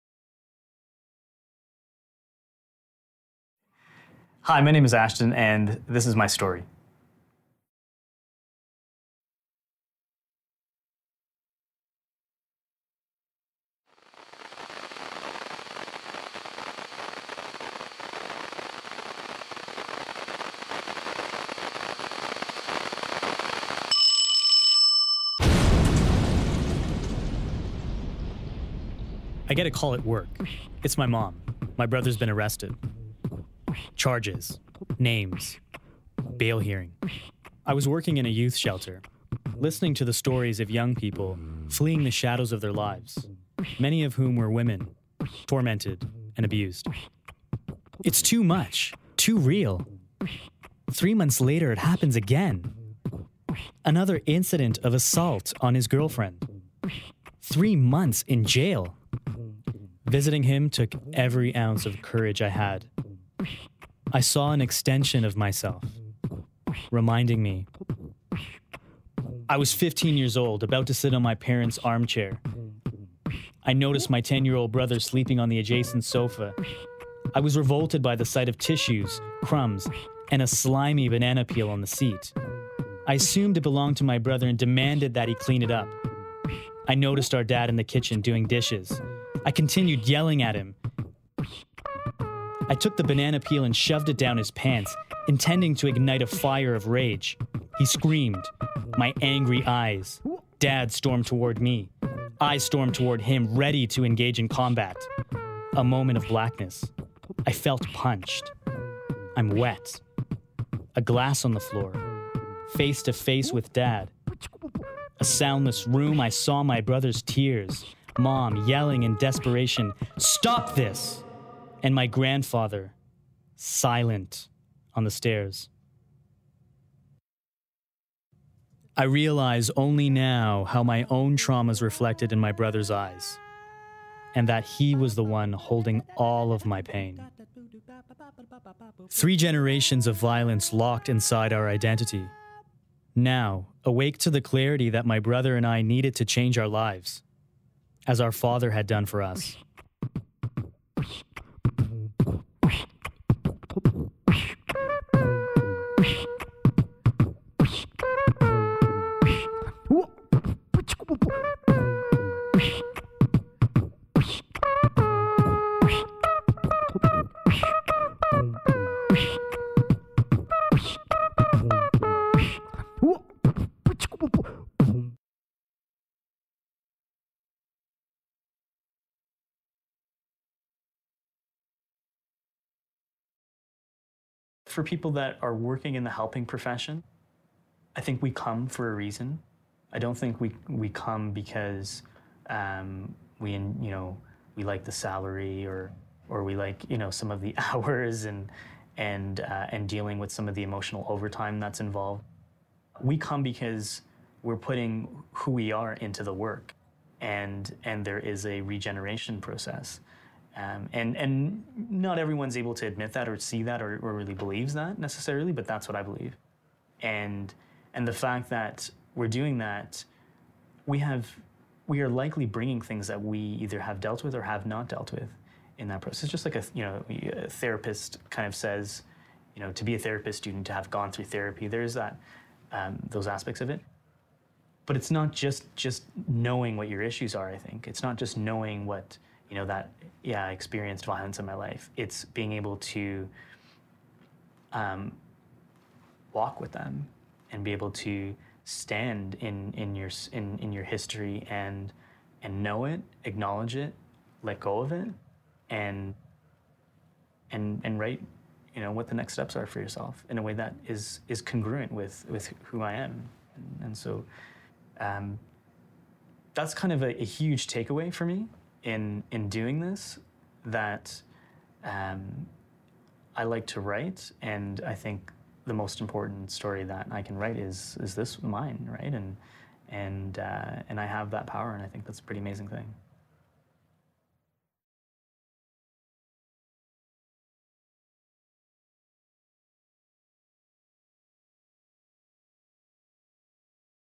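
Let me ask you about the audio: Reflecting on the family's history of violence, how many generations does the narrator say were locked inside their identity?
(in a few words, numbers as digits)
3 generations.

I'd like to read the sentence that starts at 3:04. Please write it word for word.
For people that are working in the helping profession, I think we come for a reason.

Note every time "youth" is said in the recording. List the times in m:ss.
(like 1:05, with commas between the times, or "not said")
0:38.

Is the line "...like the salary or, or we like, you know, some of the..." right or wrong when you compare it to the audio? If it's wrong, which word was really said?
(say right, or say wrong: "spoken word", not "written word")
right.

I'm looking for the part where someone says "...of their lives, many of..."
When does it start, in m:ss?
0:42.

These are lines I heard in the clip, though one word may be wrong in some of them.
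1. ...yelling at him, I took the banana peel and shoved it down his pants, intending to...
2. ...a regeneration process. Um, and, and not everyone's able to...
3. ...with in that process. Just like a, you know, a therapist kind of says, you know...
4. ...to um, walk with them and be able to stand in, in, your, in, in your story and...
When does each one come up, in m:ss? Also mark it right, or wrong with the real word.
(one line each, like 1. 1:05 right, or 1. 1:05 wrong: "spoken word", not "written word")
1. 1:30 right
2. 3:28 right
3. 3:45 right
4. 4:02 wrong: "history", not "story".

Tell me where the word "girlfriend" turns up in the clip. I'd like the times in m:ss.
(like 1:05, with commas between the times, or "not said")
0:55.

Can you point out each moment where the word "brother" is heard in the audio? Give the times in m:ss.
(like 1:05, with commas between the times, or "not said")
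0:31, 1:14, 1:24, 1:56, 2:12, 2:25.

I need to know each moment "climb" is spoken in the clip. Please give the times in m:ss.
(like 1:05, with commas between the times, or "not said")
not said.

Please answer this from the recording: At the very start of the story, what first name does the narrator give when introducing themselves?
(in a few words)
Ashton.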